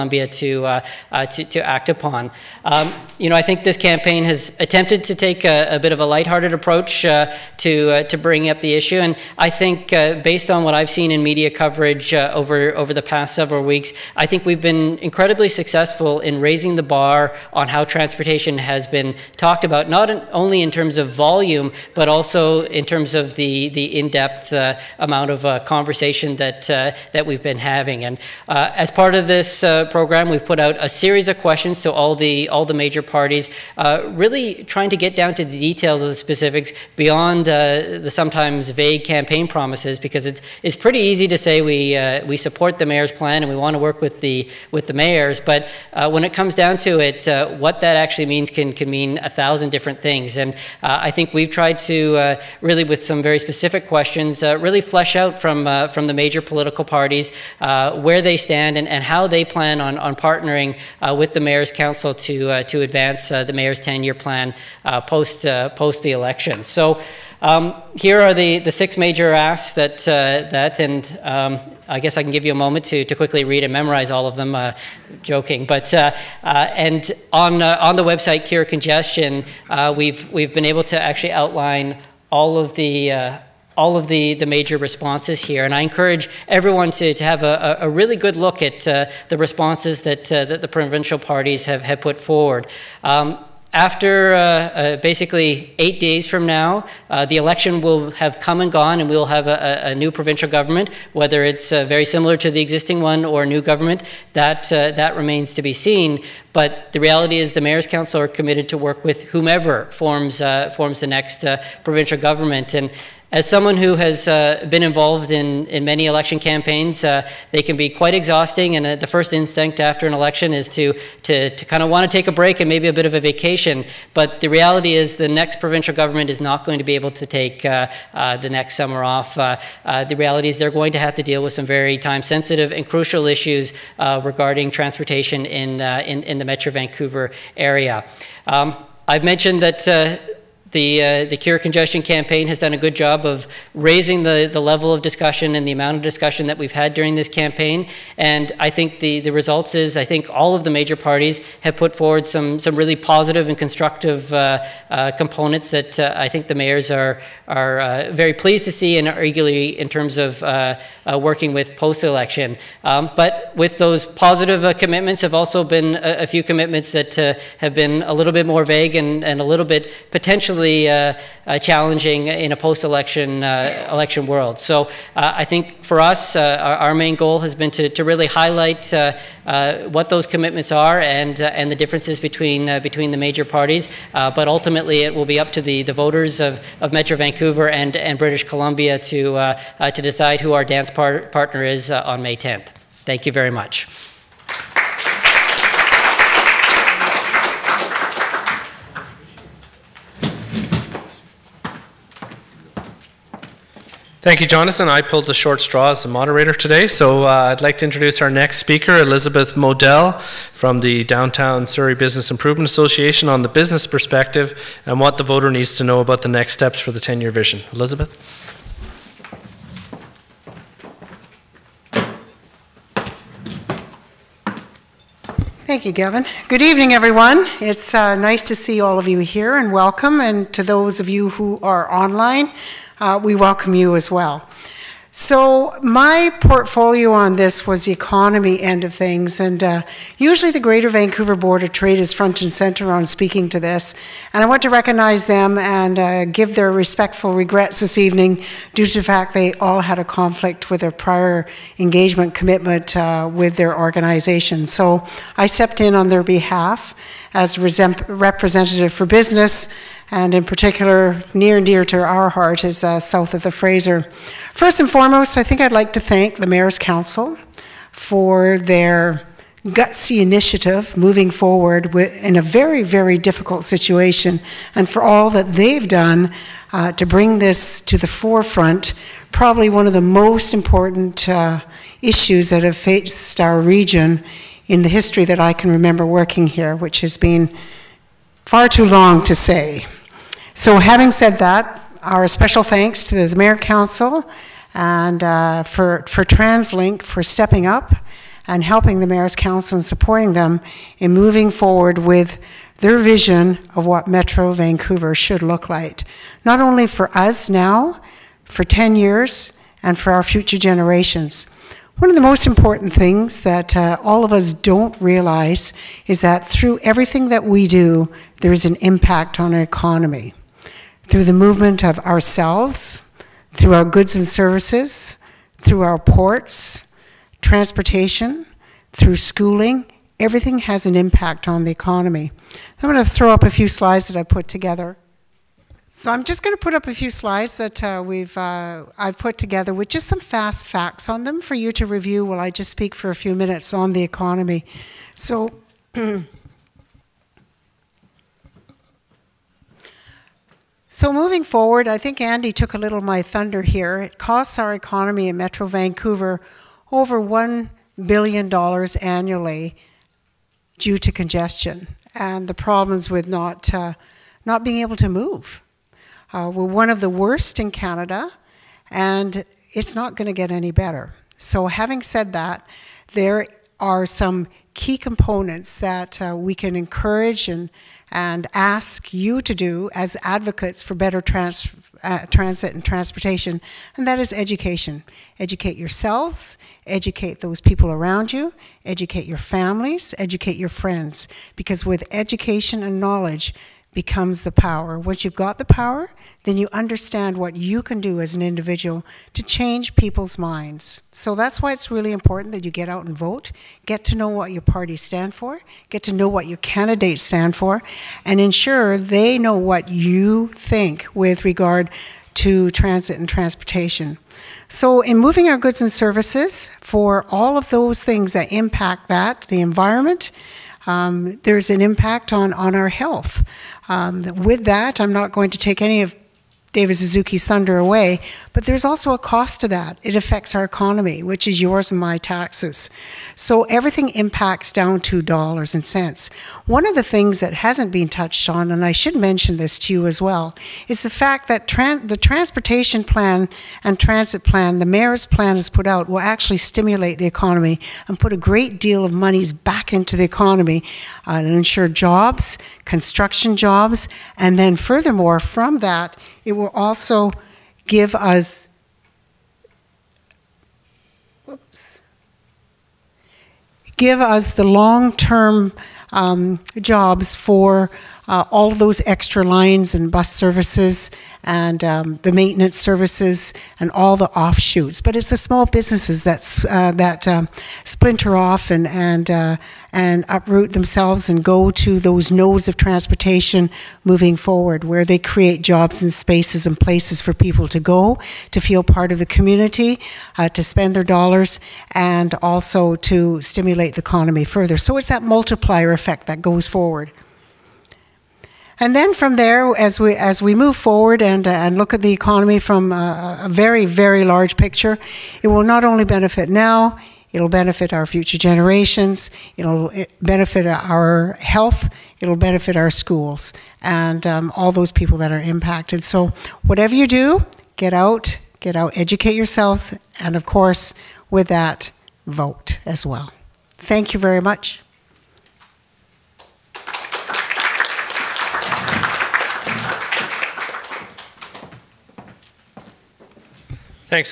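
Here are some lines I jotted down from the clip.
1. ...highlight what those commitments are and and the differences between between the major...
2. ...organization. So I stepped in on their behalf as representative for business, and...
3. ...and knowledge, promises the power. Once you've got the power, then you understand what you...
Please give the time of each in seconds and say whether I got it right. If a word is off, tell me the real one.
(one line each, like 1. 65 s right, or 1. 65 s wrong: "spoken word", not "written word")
1. 178 s right
2. 253 s right
3. 392 s wrong: "becomes", not "promises".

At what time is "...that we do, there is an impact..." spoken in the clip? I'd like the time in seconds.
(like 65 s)
317 s.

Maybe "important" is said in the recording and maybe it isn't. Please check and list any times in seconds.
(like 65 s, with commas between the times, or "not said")
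280 s, 312 s, 402 s.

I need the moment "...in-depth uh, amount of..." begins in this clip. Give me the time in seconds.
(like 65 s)
23 s.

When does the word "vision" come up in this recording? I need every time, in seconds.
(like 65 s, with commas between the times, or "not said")
217 s, 302 s.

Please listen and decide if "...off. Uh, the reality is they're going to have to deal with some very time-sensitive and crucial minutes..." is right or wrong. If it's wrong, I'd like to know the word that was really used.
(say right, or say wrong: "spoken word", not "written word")
wrong: "issues", not "minutes".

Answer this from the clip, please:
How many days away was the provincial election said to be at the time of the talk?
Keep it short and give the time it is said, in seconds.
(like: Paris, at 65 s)
8, at 95 s.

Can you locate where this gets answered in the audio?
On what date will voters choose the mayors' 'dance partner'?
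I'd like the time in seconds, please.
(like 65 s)
192 s.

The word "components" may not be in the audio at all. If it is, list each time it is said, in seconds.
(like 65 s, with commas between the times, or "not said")
155 s, 374 s.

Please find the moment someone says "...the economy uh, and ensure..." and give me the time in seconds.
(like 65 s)
450 s.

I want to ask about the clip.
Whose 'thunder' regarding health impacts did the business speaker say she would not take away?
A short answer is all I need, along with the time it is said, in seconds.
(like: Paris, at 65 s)
David Suzuki, at 426 s.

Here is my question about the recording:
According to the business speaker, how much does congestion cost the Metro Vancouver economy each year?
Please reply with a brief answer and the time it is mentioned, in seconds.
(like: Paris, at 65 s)
Over $1 billion, at 356 s.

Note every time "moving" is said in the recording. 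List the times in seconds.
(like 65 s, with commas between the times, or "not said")
270 s, 301 s, 351 s, 415 s, 484 s.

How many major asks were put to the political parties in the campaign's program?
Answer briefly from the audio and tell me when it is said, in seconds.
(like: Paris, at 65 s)
6, at 68 s.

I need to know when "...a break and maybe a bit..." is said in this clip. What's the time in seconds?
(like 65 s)
122 s.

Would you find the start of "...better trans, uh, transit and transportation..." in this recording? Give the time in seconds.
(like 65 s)
380 s.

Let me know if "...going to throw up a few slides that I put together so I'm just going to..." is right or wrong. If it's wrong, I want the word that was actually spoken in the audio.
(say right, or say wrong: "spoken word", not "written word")
right.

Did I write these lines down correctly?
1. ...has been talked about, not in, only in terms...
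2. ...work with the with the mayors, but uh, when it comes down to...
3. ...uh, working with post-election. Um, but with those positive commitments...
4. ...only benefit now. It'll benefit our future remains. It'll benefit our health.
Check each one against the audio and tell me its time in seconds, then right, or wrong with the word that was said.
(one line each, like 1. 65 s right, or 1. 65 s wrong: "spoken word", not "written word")
1. 18 s right
2. 43 s right
3. 160 s right
4. 505 s wrong: "generations", not "remains".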